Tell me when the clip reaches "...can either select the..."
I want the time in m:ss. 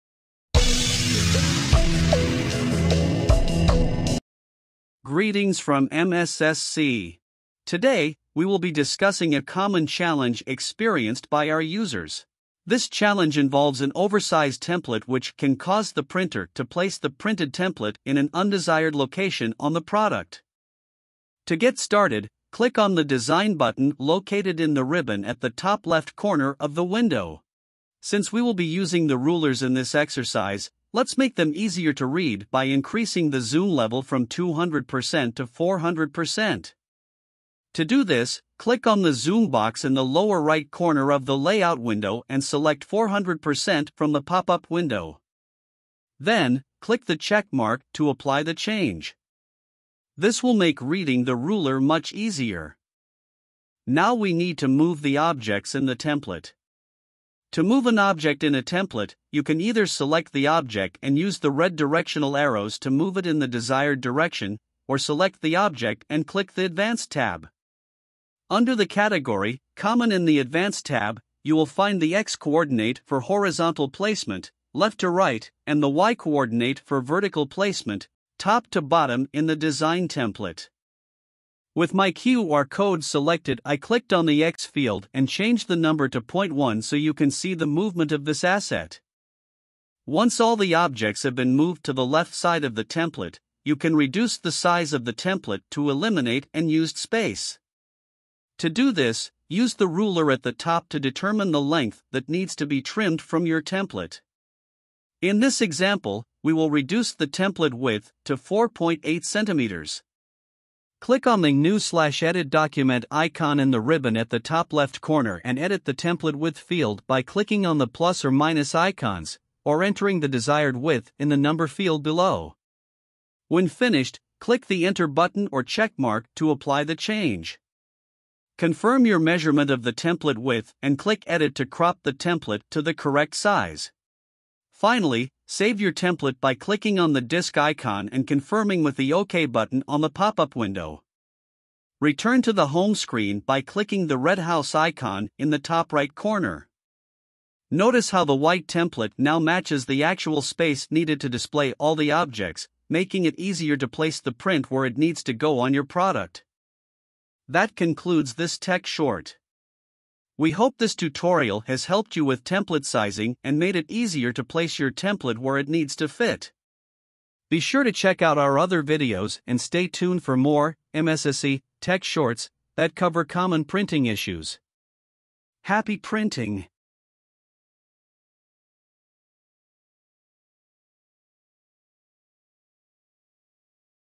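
0:59.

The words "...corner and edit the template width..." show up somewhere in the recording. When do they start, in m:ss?
1:55.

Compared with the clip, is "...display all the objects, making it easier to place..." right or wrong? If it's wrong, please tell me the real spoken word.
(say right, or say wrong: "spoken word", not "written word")
right.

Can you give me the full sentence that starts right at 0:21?
To get started, click on the Design button located in the ribbon at the top left corner of the window.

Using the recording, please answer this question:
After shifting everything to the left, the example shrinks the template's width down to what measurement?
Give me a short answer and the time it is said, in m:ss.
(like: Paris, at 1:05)
4.8 centimeters, at 1:48.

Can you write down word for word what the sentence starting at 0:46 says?
Then, click the check mark to apply the change.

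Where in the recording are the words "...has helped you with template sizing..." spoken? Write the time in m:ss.
2:41.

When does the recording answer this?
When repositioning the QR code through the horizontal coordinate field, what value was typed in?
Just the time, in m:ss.
1:26.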